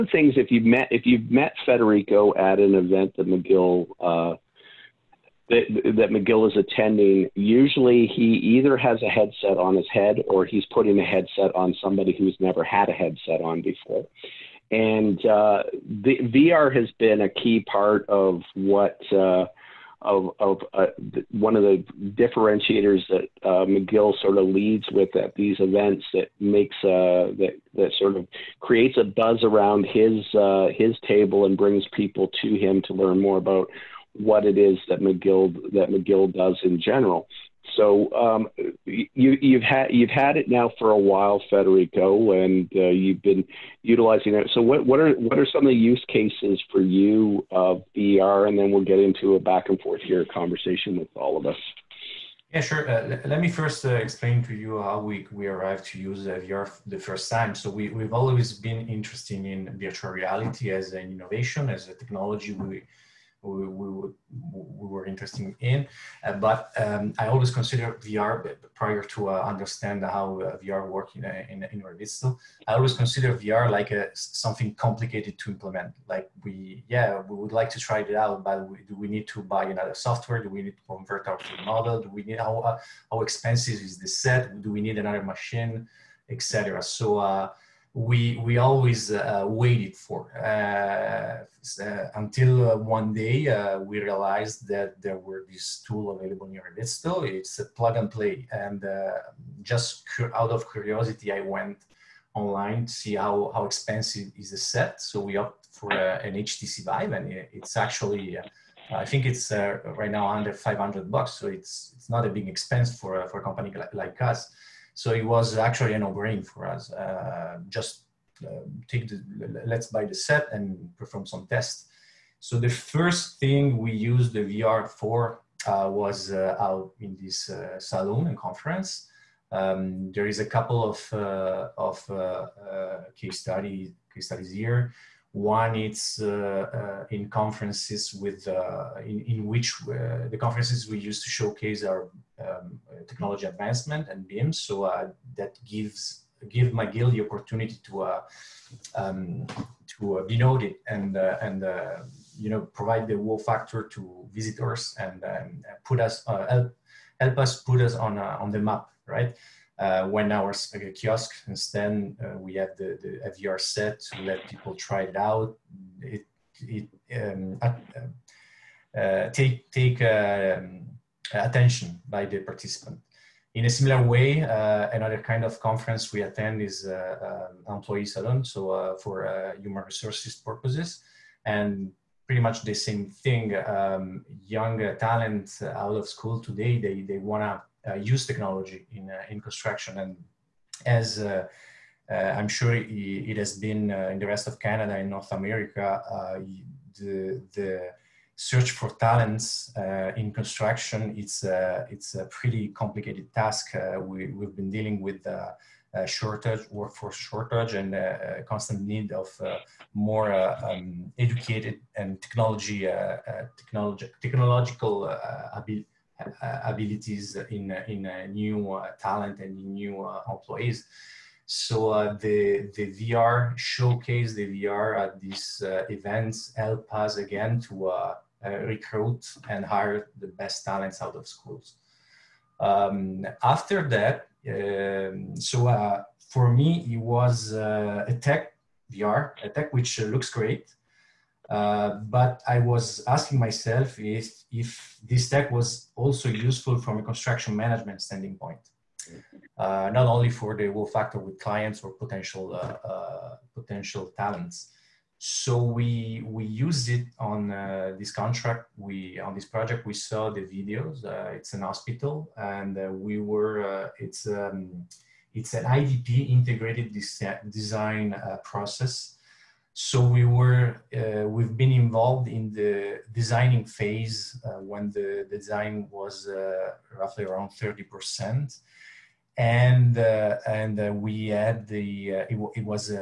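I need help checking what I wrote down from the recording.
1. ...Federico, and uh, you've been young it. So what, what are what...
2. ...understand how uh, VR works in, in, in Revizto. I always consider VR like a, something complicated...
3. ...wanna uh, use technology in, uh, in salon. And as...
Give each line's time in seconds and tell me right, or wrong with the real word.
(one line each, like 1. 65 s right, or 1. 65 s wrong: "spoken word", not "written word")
1. 41 s wrong: "utilizing", not "young"
2. 69 s right
3. 187 s wrong: "construction", not "salon".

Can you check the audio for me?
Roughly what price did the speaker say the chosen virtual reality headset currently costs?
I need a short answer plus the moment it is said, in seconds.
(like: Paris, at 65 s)
under $500, at 110 s.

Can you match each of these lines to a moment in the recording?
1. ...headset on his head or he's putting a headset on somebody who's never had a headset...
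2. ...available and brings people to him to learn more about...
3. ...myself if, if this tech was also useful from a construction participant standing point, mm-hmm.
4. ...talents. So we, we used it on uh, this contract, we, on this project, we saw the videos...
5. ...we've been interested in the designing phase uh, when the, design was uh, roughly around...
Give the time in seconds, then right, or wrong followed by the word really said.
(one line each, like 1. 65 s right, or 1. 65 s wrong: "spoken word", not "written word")
1. 9 s right
2. 31 s wrong: "table", not "available"
3. 243 s wrong: "management", not "participant"
4. 254 s right
5. 271 s wrong: "involved", not "interested".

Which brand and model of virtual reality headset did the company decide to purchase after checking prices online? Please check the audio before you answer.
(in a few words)
HTC Vive.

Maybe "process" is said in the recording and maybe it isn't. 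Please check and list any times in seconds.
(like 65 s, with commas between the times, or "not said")
268 s.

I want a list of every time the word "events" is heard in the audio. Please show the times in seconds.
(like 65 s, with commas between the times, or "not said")
2 s, 25 s, 225 s.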